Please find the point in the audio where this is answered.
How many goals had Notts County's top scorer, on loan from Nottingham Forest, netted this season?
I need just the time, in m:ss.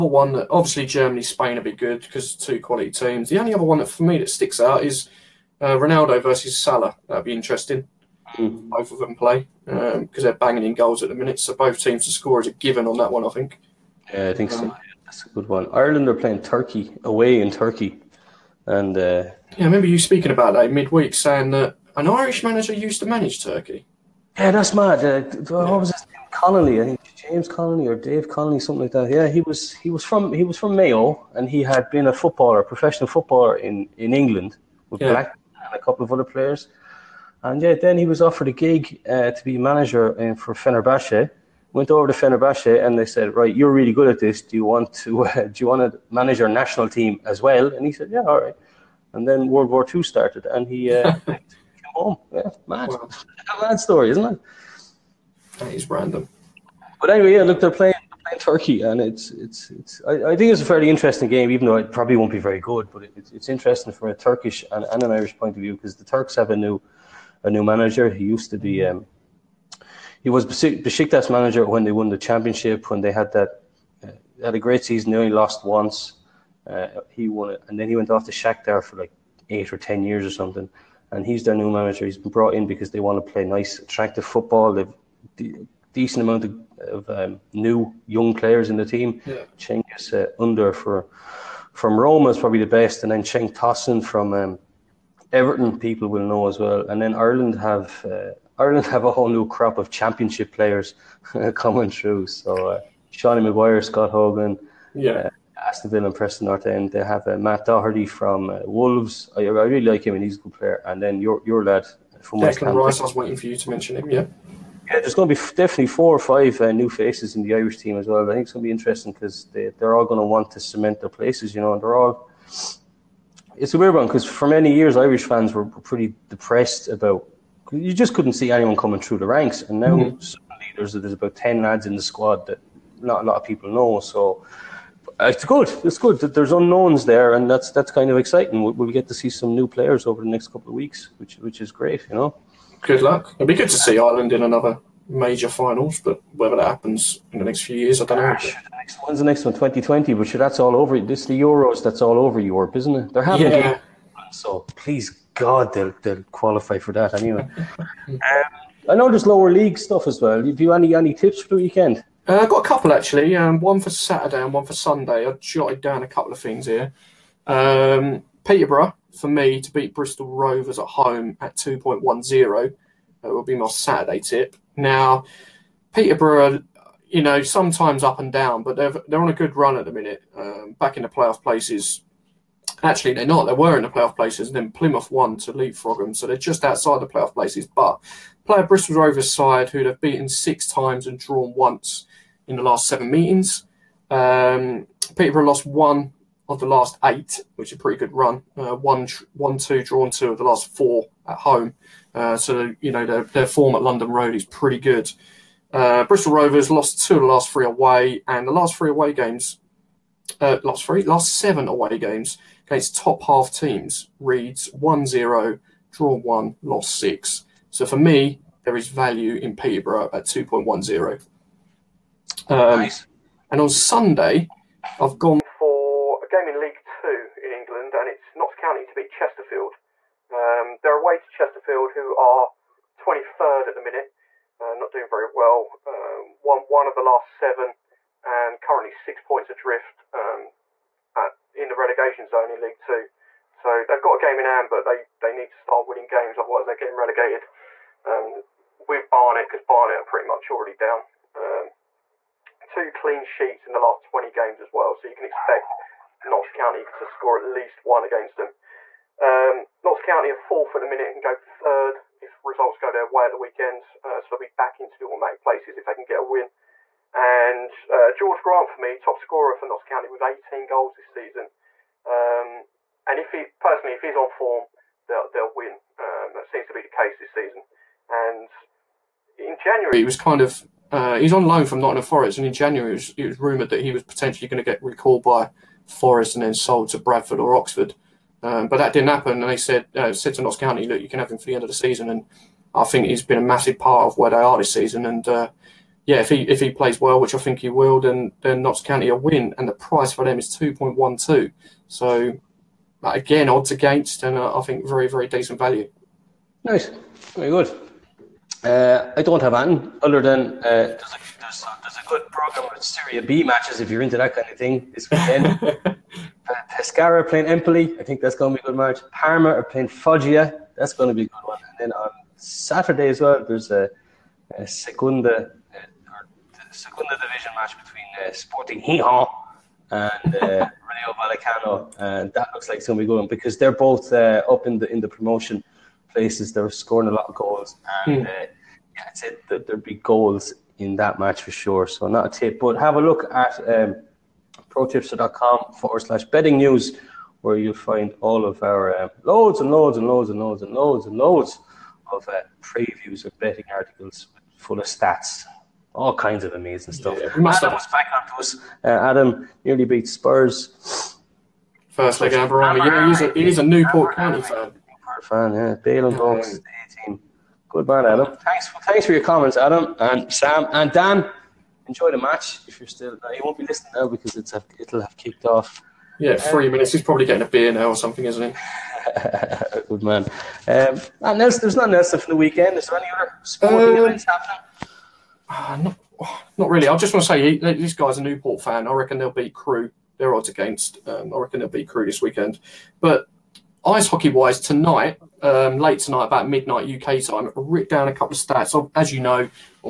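4:30.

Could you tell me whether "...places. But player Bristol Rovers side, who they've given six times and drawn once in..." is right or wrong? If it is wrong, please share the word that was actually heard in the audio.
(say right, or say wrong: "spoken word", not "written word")
wrong: "beaten", not "given".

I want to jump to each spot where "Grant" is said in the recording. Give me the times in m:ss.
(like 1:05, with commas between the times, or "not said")
4:28.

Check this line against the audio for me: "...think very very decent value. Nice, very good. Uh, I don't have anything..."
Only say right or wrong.
right.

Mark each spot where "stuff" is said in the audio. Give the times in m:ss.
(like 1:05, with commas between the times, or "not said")
2:39, 5:56.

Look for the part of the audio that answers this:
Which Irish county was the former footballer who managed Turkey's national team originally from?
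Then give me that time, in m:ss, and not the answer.
0:30.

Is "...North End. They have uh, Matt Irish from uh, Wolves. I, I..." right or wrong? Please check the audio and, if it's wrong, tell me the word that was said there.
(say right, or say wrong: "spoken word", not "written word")
wrong: "Doherty", not "Irish".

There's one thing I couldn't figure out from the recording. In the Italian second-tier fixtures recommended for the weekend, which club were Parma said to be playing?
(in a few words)
Foggia.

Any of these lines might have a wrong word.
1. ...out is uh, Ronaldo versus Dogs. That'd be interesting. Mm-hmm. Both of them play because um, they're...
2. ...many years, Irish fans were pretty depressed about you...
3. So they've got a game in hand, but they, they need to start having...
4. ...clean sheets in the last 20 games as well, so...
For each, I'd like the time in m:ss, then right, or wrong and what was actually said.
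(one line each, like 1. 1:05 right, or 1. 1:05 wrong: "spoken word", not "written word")
1. 0:04 wrong: "Salah", not "Dogs"
2. 2:04 right
3. 4:03 wrong: "winning", not "having"
4. 4:12 right.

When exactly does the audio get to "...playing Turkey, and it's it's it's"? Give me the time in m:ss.
0:58.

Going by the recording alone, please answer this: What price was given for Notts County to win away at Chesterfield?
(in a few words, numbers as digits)
2.12.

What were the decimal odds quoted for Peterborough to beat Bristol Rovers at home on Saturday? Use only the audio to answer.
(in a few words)
2.10.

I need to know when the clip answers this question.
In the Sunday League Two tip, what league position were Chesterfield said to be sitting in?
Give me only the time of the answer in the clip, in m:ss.
3:52.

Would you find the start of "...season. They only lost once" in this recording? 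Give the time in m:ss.
1:14.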